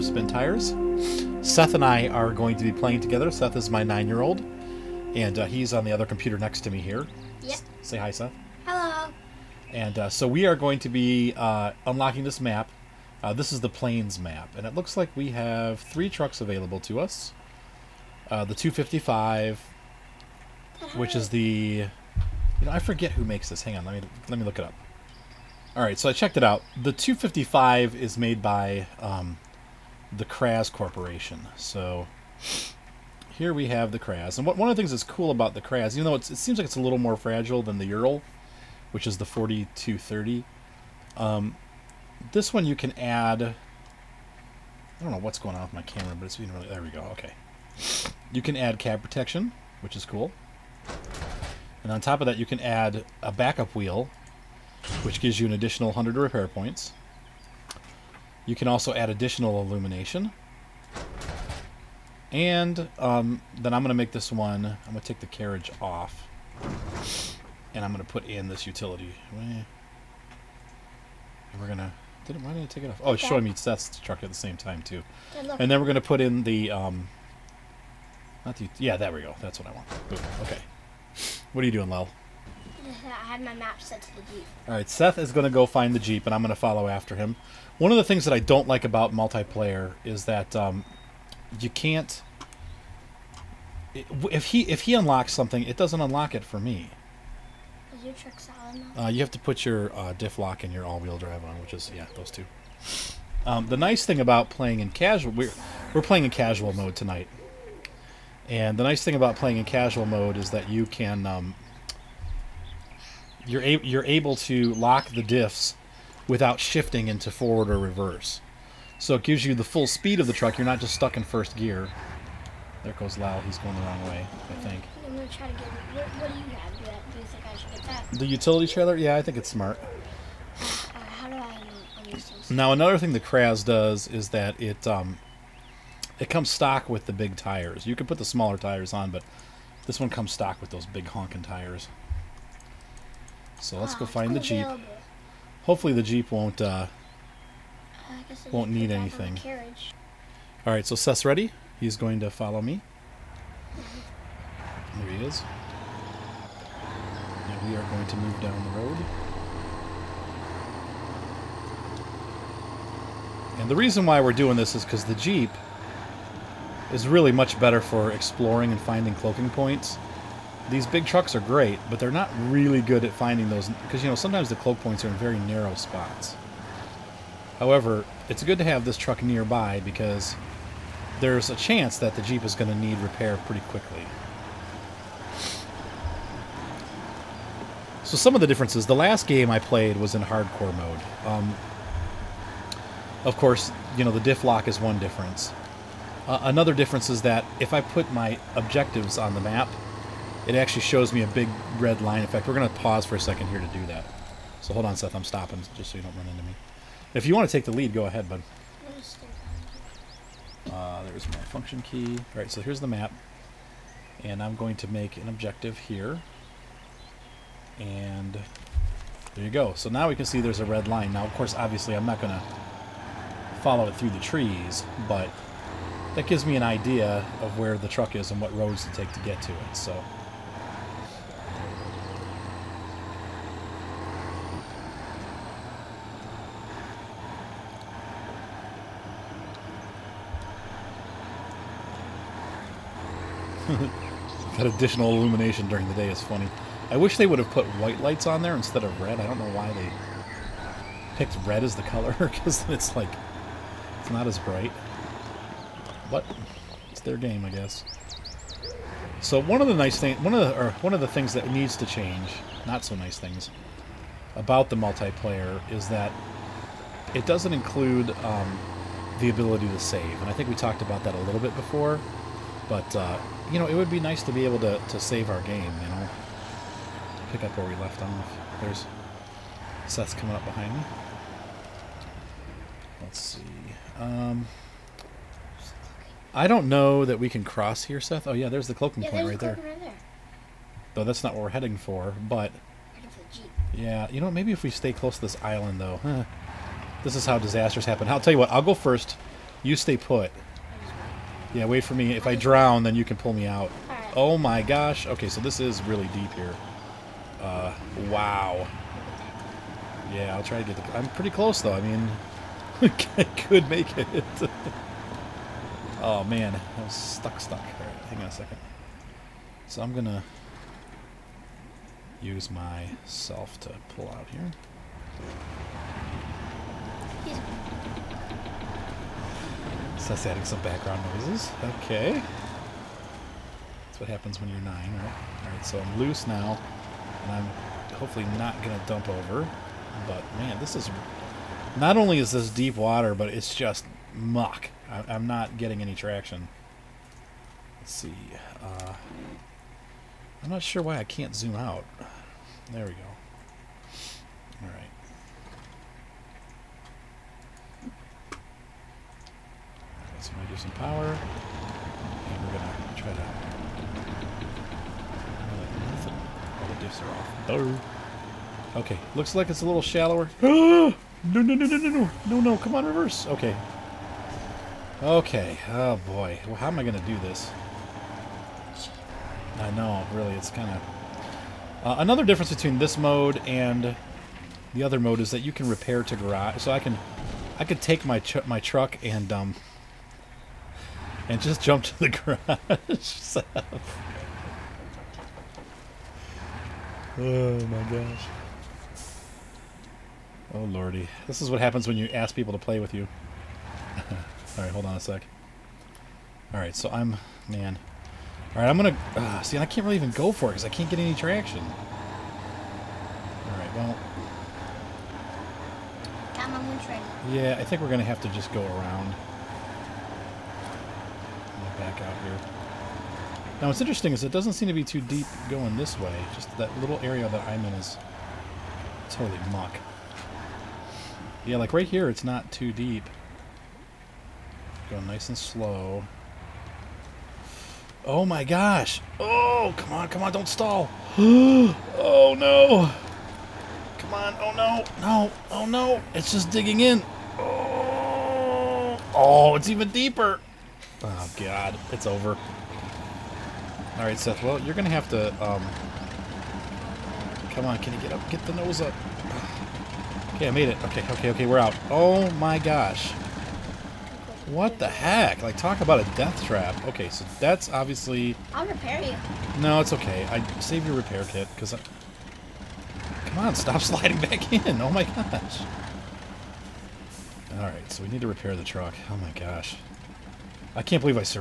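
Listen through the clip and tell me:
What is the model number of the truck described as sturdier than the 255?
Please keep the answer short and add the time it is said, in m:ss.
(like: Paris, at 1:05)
4230, at 0:39.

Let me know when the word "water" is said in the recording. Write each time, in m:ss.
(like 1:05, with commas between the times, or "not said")
5:42.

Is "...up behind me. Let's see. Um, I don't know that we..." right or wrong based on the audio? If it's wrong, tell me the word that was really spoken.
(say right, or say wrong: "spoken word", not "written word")
right.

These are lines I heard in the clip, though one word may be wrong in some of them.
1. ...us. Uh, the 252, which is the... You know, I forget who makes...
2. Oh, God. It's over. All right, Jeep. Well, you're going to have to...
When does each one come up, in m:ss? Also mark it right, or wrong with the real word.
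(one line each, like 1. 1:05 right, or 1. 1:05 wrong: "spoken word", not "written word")
1. 0:16 wrong: "255", not "252"
2. 7:31 wrong: "Seth", not "Jeep".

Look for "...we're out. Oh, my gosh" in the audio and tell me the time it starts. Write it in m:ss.
7:41.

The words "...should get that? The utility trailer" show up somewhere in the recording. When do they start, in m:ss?
2:07.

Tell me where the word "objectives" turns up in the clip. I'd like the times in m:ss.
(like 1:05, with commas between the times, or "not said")
3:18, 3:35.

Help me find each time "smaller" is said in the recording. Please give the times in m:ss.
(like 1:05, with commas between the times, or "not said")
2:18.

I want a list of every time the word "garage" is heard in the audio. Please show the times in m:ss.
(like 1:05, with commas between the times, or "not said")
6:26, 6:32.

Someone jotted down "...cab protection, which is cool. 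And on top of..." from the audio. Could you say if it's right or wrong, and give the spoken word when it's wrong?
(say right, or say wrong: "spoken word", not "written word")
right.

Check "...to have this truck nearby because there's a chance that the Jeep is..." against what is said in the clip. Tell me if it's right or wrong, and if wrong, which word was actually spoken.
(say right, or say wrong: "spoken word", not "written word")
right.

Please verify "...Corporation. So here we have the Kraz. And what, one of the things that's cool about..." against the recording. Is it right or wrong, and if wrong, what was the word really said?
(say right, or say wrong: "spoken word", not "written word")
right.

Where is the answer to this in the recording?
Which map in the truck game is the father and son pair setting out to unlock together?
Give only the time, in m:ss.
0:13.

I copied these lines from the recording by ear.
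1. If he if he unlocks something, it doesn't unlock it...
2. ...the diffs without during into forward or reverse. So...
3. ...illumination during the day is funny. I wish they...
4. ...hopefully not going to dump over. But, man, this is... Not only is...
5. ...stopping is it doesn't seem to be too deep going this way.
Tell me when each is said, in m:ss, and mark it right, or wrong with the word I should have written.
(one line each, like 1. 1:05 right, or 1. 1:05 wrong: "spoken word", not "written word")
1. 1:34 right
2. 1:55 wrong: "shifting", not "during"
3. 4:05 right
4. 5:37 right
5. 7:03 wrong: "interesting", not "stopping".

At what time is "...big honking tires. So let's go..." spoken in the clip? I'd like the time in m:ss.
2:20.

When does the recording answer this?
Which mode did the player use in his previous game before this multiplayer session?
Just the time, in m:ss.
3:10.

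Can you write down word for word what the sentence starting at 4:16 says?
But it's their game, I guess.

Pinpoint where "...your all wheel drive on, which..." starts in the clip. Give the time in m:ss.
1:40.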